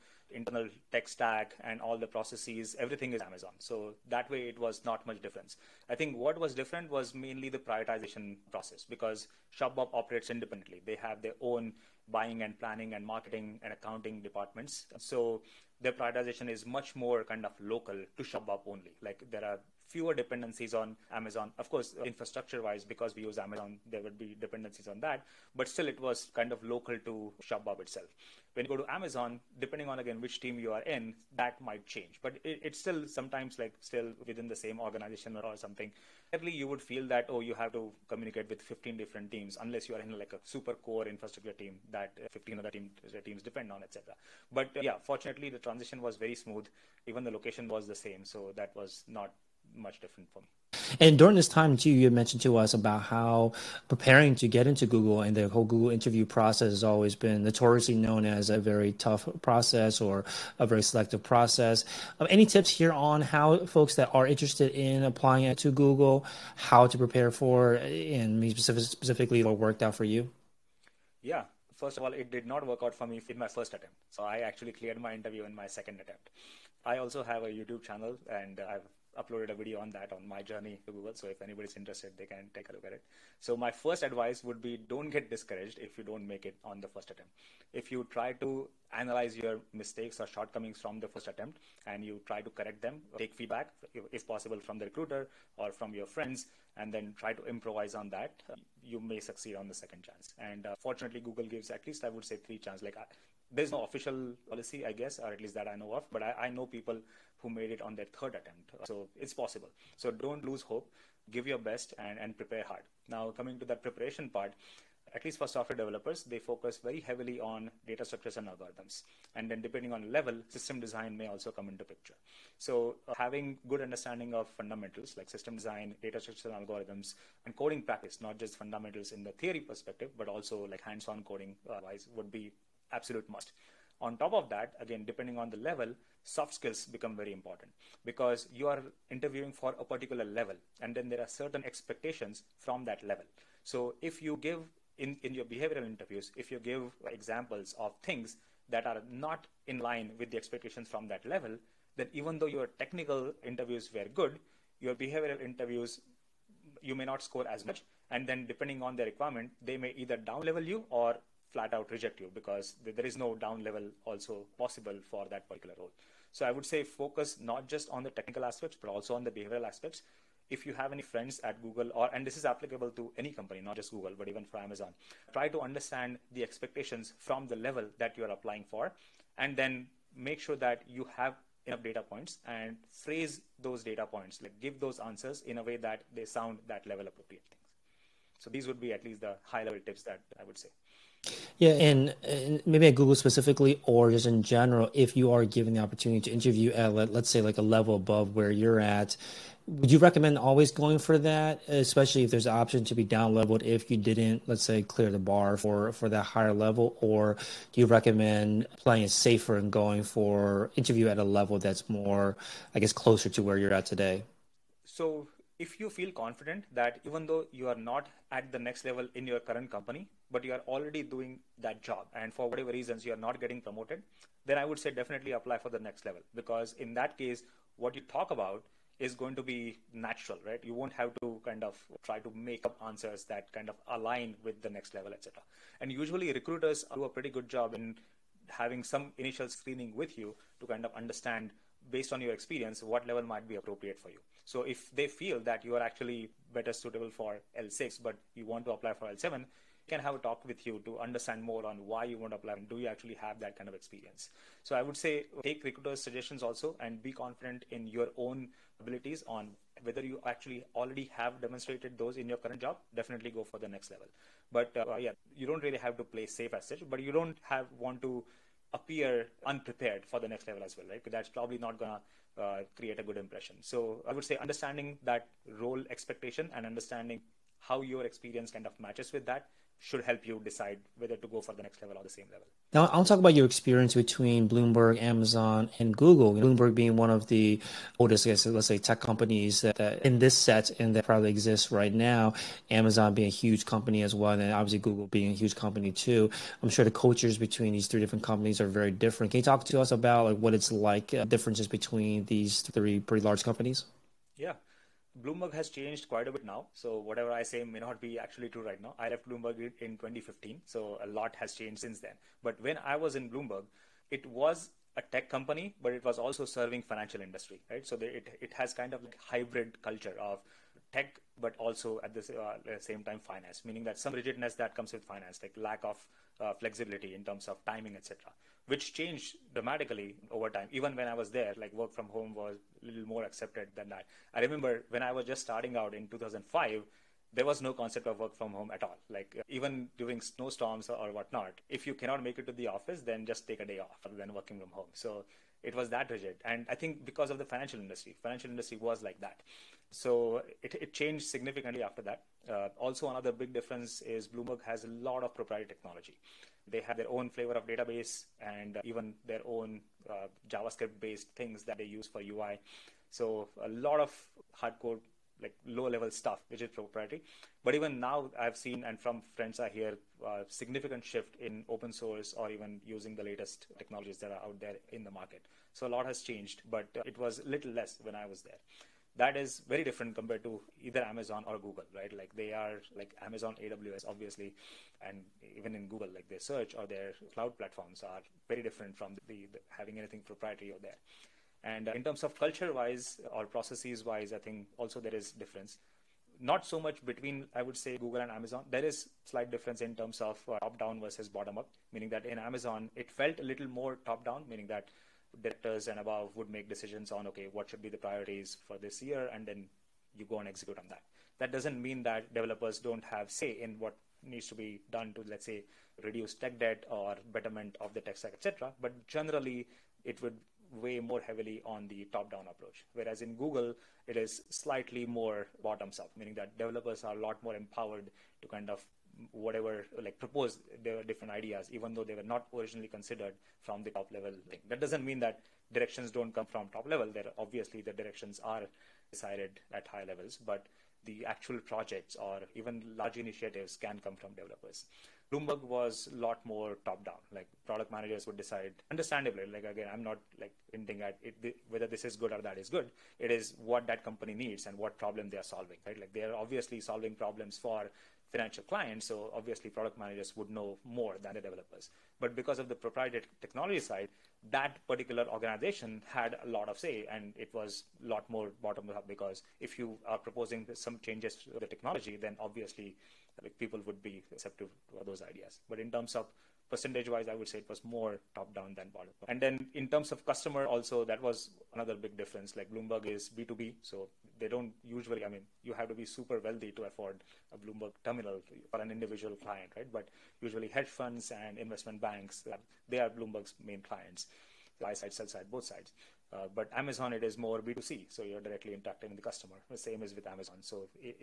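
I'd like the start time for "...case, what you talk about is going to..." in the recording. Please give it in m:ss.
3:47.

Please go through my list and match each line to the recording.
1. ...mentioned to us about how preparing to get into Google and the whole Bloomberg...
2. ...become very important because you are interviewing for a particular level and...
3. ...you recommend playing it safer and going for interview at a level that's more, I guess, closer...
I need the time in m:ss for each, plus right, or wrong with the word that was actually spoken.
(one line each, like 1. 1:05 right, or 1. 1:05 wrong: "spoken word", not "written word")
1. 0:52 wrong: "Google", not "Bloomberg"
2. 2:16 right
3. 3:27 right.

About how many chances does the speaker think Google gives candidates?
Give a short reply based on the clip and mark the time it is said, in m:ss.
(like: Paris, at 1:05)
3, at 1:42.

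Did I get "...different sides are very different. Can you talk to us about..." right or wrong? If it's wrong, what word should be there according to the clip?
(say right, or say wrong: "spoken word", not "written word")
wrong: "companies", not "sides".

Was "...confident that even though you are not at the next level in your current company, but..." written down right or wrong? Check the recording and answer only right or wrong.
right.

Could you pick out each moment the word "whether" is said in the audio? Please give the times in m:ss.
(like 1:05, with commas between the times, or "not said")
4:19, 4:40, 7:31.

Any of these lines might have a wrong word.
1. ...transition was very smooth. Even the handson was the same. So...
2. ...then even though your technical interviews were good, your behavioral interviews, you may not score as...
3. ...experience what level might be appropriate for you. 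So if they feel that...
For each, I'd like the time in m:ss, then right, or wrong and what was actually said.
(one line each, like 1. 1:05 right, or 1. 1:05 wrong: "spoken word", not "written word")
1. 0:45 wrong: "location", not "handson"
2. 2:31 right
3. 4:02 right.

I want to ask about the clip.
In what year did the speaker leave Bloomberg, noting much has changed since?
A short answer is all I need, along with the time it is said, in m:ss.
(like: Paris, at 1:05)
2015, at 5:09.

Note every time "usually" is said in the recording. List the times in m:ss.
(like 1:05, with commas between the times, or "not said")
3:55, 8:04, 8:10.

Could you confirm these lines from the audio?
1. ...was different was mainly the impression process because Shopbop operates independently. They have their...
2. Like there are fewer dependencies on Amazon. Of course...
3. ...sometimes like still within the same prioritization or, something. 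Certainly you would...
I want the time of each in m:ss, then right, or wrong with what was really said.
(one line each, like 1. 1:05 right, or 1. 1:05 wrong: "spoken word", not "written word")
1. 0:06 wrong: "prioritization", not "impression"
2. 0:19 right
3. 0:33 wrong: "organization", not "prioritization".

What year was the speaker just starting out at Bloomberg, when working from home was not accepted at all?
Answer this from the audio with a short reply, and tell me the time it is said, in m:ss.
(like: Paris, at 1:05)
2005, at 5:36.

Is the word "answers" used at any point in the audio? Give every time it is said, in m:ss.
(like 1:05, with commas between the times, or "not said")
3:04, 3:52.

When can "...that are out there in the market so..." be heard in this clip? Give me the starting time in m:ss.
6:14.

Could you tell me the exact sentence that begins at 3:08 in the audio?
So these would be at least the high level tips that I would say.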